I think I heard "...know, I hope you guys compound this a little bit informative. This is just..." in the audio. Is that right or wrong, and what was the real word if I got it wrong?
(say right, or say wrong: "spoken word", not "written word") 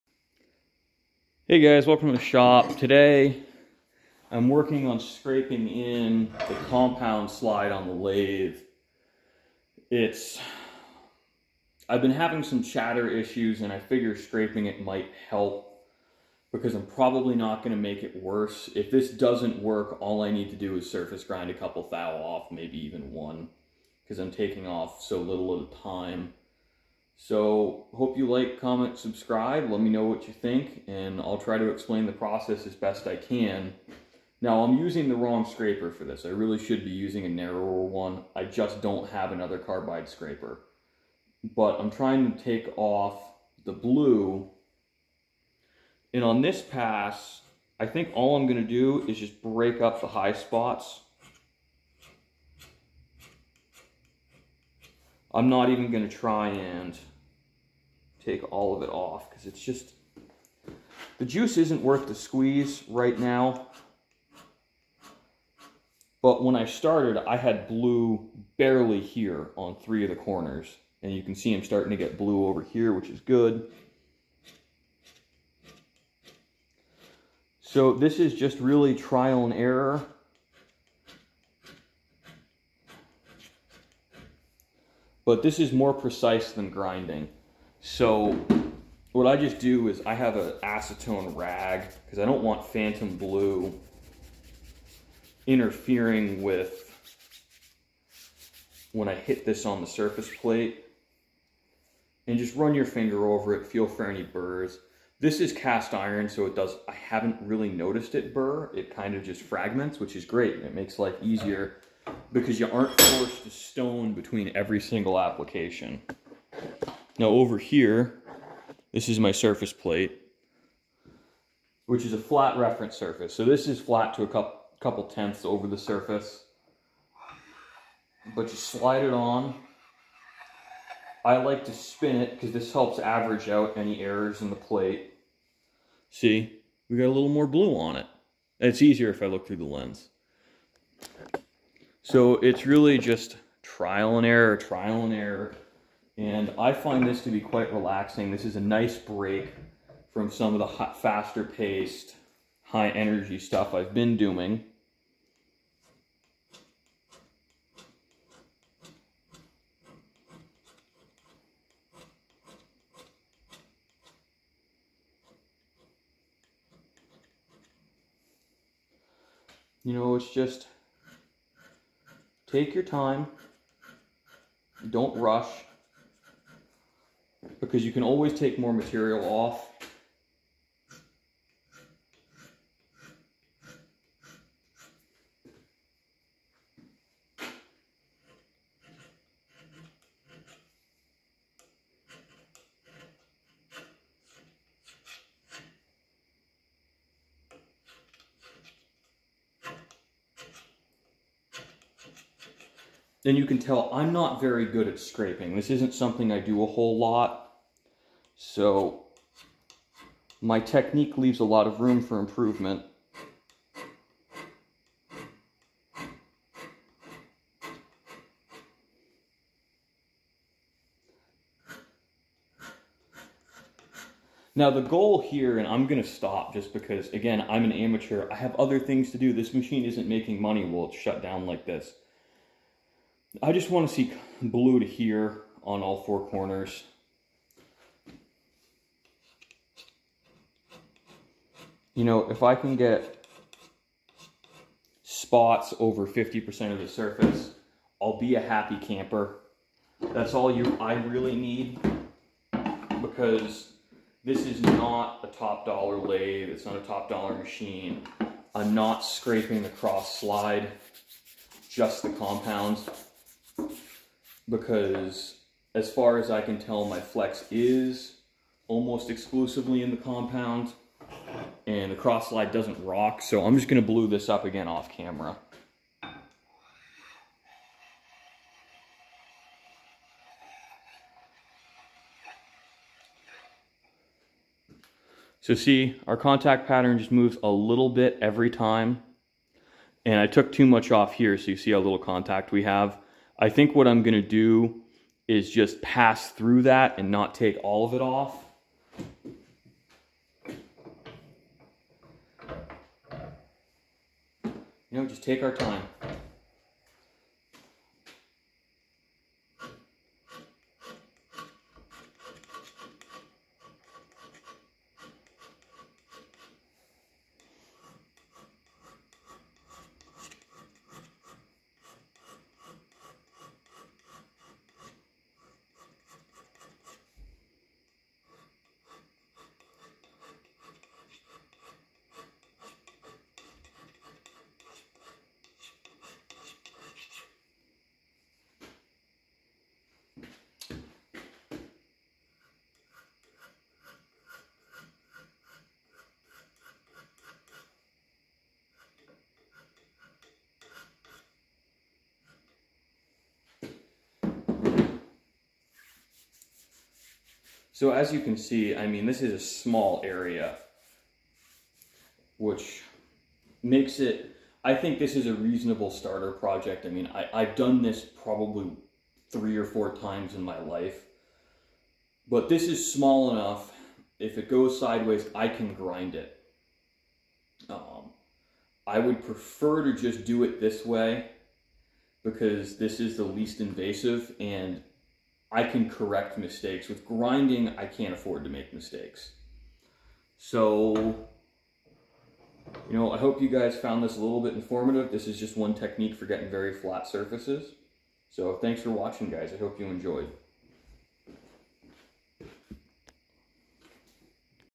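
wrong: "found", not "compound".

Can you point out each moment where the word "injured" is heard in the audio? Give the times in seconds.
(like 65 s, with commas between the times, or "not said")
not said.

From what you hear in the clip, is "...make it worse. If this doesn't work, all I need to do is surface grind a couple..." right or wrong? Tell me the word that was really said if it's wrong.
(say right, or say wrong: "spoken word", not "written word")
right.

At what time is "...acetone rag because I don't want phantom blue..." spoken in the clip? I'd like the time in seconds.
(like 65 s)
90 s.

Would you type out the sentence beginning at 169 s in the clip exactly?
You know, it's just take your time, don't rush because you can always take more material off.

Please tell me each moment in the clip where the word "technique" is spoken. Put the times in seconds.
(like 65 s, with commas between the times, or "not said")
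210 s, 395 s.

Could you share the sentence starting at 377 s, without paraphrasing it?
Um, I would prefer to just do it this way because this is the least invasive and I can correct mistakes.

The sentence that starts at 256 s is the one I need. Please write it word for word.
It's not a top dollar machine.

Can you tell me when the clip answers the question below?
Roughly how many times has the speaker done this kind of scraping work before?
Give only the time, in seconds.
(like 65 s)
369 s.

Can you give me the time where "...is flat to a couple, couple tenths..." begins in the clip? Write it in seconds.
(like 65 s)
123 s.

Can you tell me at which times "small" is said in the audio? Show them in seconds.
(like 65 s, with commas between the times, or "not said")
359 s, 372 s.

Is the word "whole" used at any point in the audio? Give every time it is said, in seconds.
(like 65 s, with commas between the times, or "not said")
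206 s.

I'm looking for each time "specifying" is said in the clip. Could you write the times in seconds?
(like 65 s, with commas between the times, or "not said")
not said.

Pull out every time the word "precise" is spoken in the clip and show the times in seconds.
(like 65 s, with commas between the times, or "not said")
85 s.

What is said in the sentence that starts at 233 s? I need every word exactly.
I just wanna see blue to here on all four corners.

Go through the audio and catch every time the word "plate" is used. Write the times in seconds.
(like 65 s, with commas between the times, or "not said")
100 s, 119 s, 134 s.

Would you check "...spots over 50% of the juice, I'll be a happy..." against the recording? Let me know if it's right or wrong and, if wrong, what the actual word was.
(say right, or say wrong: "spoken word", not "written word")
wrong: "surface", not "juice".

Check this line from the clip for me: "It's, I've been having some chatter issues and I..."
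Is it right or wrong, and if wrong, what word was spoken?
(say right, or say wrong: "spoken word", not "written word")
right.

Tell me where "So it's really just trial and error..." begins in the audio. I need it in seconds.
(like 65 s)
142 s.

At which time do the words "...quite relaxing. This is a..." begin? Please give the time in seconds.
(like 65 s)
147 s.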